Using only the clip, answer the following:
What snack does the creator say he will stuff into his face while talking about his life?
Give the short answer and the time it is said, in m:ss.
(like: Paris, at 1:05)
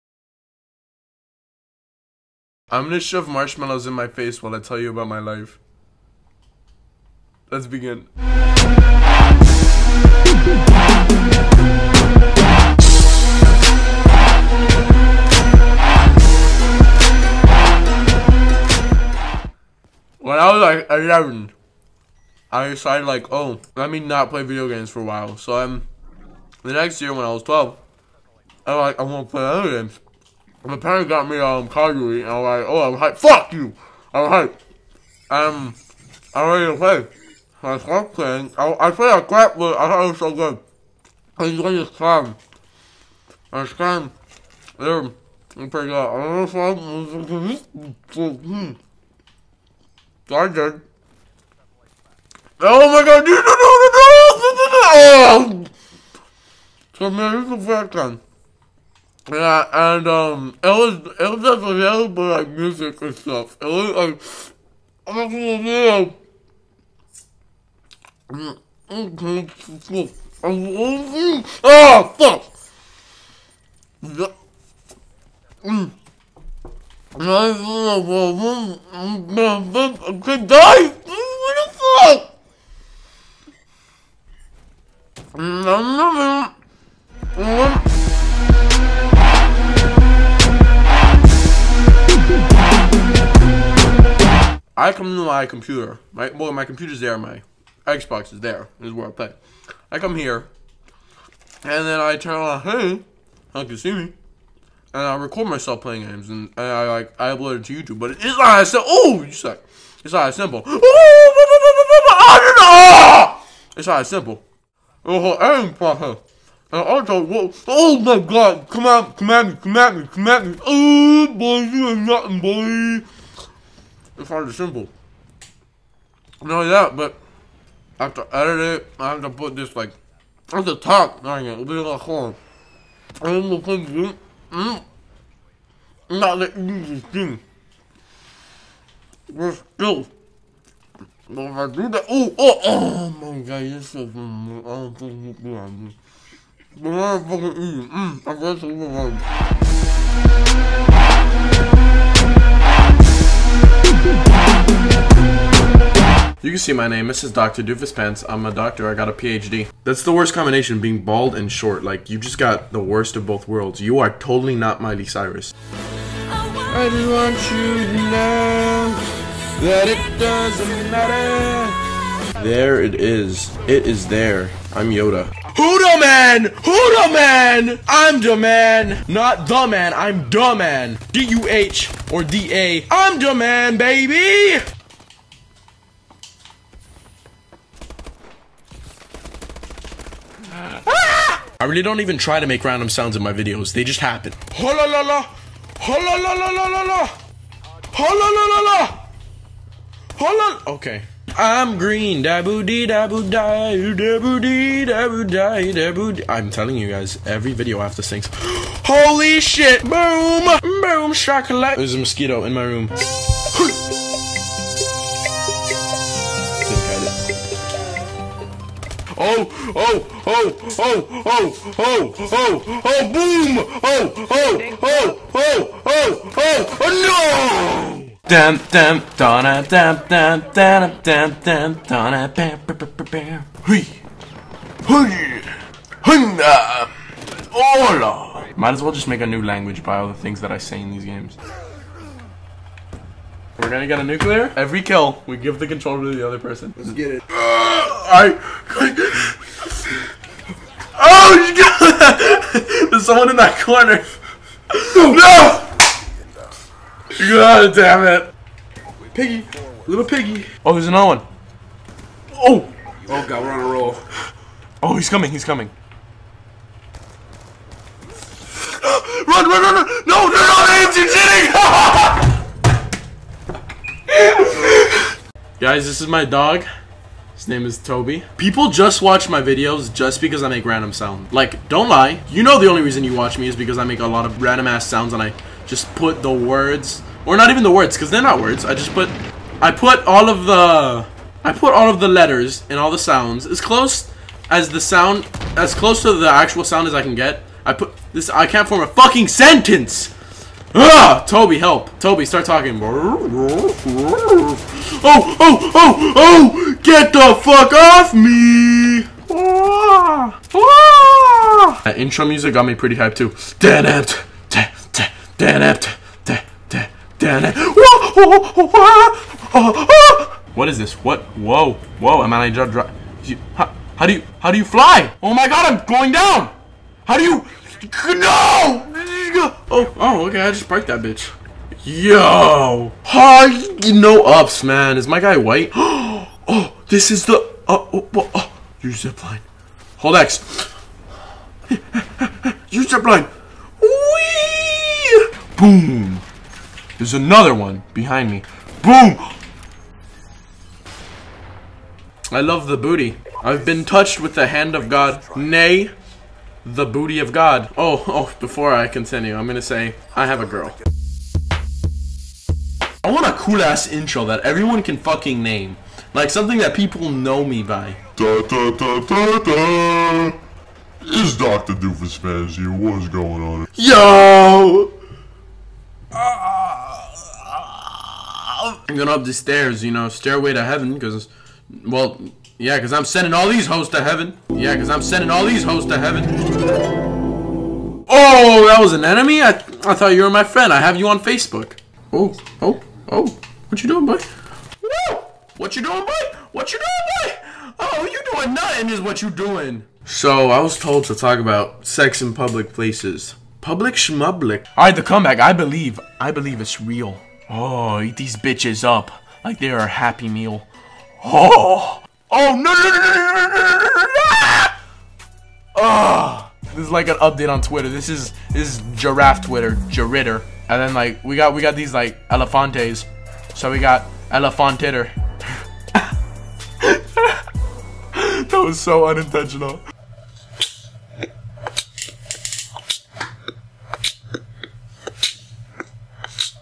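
Marshmallows, at 0:03.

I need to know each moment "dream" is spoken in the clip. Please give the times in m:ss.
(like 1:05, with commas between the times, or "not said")
not said.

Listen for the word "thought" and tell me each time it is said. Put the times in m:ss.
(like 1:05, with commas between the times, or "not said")
0:39, 6:29.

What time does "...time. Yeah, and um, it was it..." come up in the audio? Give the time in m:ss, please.
0:57.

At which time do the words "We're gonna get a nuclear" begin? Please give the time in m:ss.
4:03.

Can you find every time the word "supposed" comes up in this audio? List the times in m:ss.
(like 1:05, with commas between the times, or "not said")
not said.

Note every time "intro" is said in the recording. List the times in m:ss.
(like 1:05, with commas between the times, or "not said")
5:11, 6:03.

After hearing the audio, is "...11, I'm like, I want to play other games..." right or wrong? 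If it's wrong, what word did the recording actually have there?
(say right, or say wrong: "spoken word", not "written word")
wrong: "12", not "11".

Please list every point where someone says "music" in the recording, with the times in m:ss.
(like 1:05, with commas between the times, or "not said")
1:02, 5:12.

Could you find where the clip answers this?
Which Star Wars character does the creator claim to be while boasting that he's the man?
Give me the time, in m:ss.
2:54.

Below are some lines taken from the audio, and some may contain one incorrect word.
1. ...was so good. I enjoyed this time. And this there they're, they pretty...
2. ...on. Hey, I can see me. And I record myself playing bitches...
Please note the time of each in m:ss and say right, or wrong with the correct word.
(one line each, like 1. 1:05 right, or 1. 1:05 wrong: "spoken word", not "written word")
1. 0:40 right
2. 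1:42 wrong: "games", not "bitches".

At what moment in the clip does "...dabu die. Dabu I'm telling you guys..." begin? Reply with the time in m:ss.
3:22.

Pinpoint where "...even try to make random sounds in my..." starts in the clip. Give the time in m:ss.
3:12.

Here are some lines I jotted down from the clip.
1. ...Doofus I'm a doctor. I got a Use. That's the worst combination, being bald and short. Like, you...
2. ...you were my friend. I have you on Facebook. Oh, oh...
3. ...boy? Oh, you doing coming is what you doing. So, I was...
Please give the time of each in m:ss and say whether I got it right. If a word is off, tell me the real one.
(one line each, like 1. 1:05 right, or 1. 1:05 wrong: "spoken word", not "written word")
1. 2:37 wrong: "PhD", not "Use"
2. 6:30 right
3. 6:37 wrong: "nothing", not "coming".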